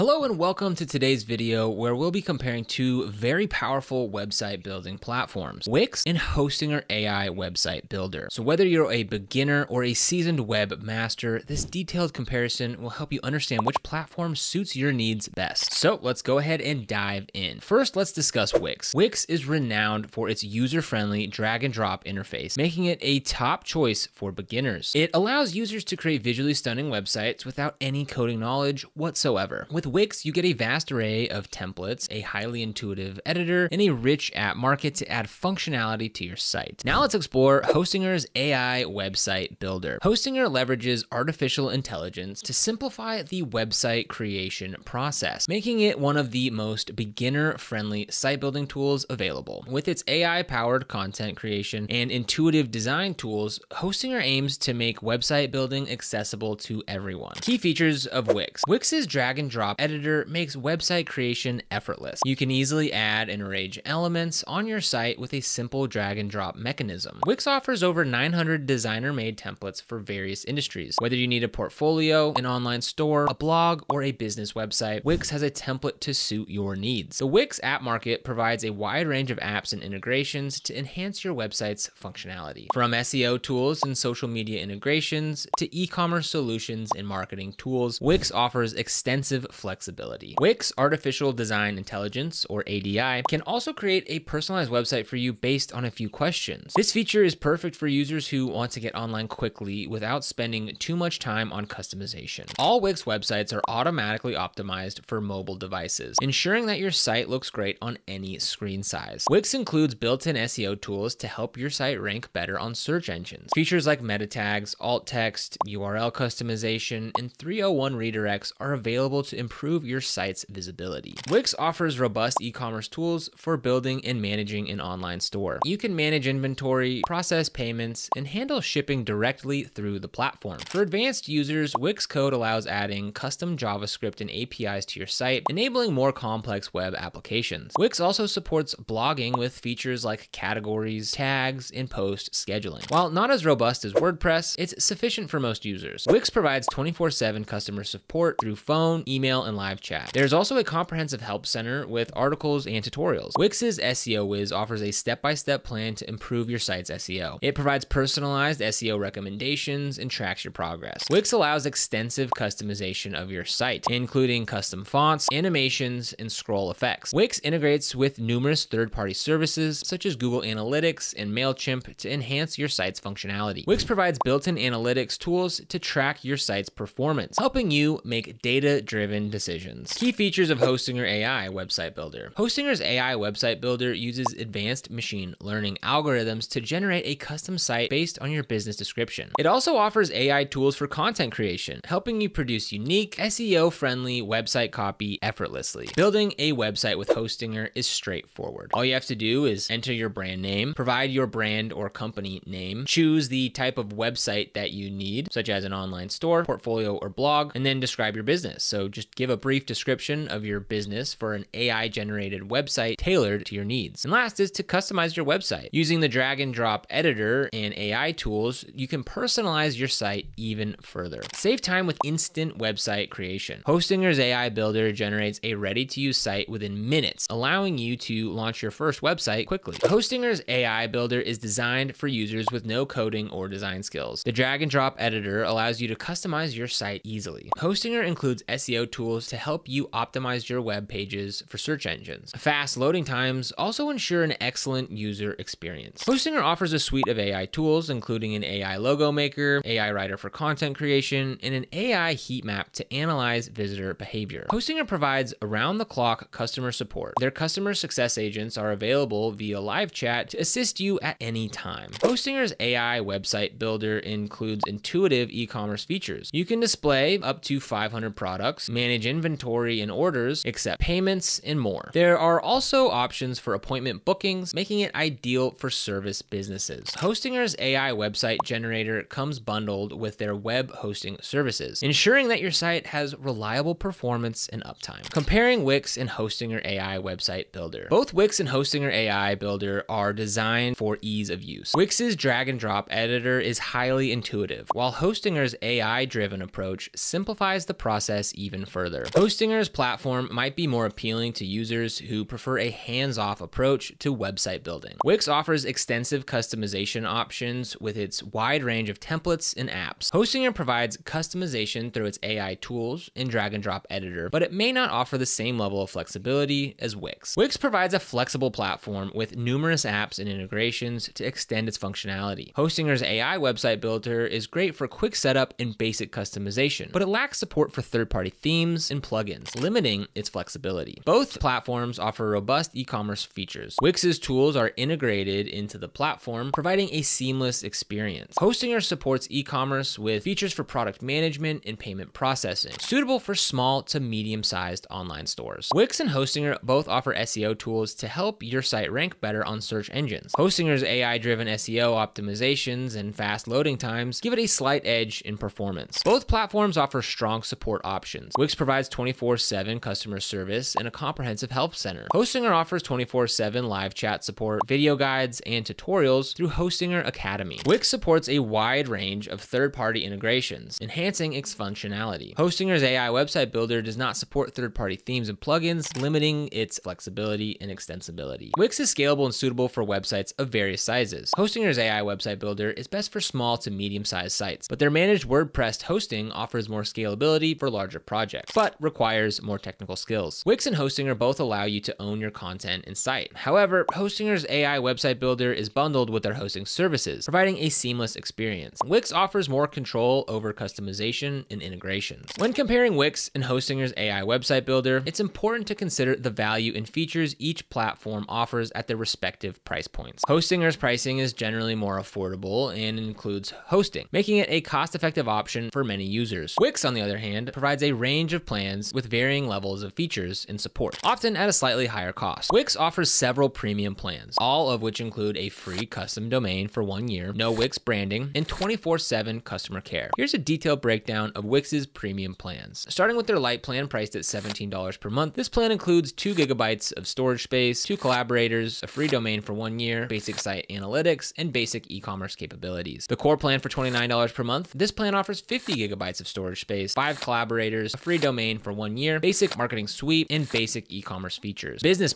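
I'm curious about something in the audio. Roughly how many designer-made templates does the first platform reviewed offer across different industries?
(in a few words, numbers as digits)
900.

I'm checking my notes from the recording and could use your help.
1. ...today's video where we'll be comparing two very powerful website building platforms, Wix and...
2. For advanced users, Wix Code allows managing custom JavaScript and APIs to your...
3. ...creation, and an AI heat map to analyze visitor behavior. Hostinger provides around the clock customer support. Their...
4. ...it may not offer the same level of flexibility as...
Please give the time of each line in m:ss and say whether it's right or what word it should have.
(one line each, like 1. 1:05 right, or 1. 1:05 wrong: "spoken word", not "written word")
1. 0:00 right
2. 2:10 wrong: "adding", not "managing"
3. 4:10 right
4. 5:14 right.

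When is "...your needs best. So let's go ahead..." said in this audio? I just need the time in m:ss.
0:14.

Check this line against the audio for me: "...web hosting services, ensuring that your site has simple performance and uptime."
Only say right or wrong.
wrong.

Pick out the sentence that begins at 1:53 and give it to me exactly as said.
Features like meta tags, alt text, URL customization, and 301 redirects are available to improve improve your site's visibility.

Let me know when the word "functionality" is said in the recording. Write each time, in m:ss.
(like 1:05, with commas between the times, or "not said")
0:35, 1:21, 2:52, 5:21, 6:11.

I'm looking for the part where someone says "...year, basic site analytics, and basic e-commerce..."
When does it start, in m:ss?
7:19.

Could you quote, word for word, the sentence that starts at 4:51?
Wix's drag and drop editor is highly intuitive, while Hostinger's AI driven approach simplifies the process even further further.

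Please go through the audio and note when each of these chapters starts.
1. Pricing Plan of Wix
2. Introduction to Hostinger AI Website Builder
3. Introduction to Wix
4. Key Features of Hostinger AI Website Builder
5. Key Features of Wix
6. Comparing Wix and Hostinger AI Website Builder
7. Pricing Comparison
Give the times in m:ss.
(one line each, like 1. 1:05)
1. 7:01
2. 0:36
3. 0:16
4. 2:59
5. 0:56
6. 4:44
7. 6:41.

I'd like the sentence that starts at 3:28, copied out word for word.
So just Give a brief description of your business for an AI generated website tailored to your needs.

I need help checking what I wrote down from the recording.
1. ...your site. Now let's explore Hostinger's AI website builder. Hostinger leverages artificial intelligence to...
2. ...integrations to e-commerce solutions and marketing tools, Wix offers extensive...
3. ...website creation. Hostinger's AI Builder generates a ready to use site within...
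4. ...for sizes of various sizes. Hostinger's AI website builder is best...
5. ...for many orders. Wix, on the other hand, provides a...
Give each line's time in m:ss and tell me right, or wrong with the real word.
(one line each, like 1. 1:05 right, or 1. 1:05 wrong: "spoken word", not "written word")
1. 0:36 right
2. 1:24 right
3. 3:42 right
4. 6:19 wrong: "websites", not "sizes"
5. 6:55 wrong: "users", not "orders".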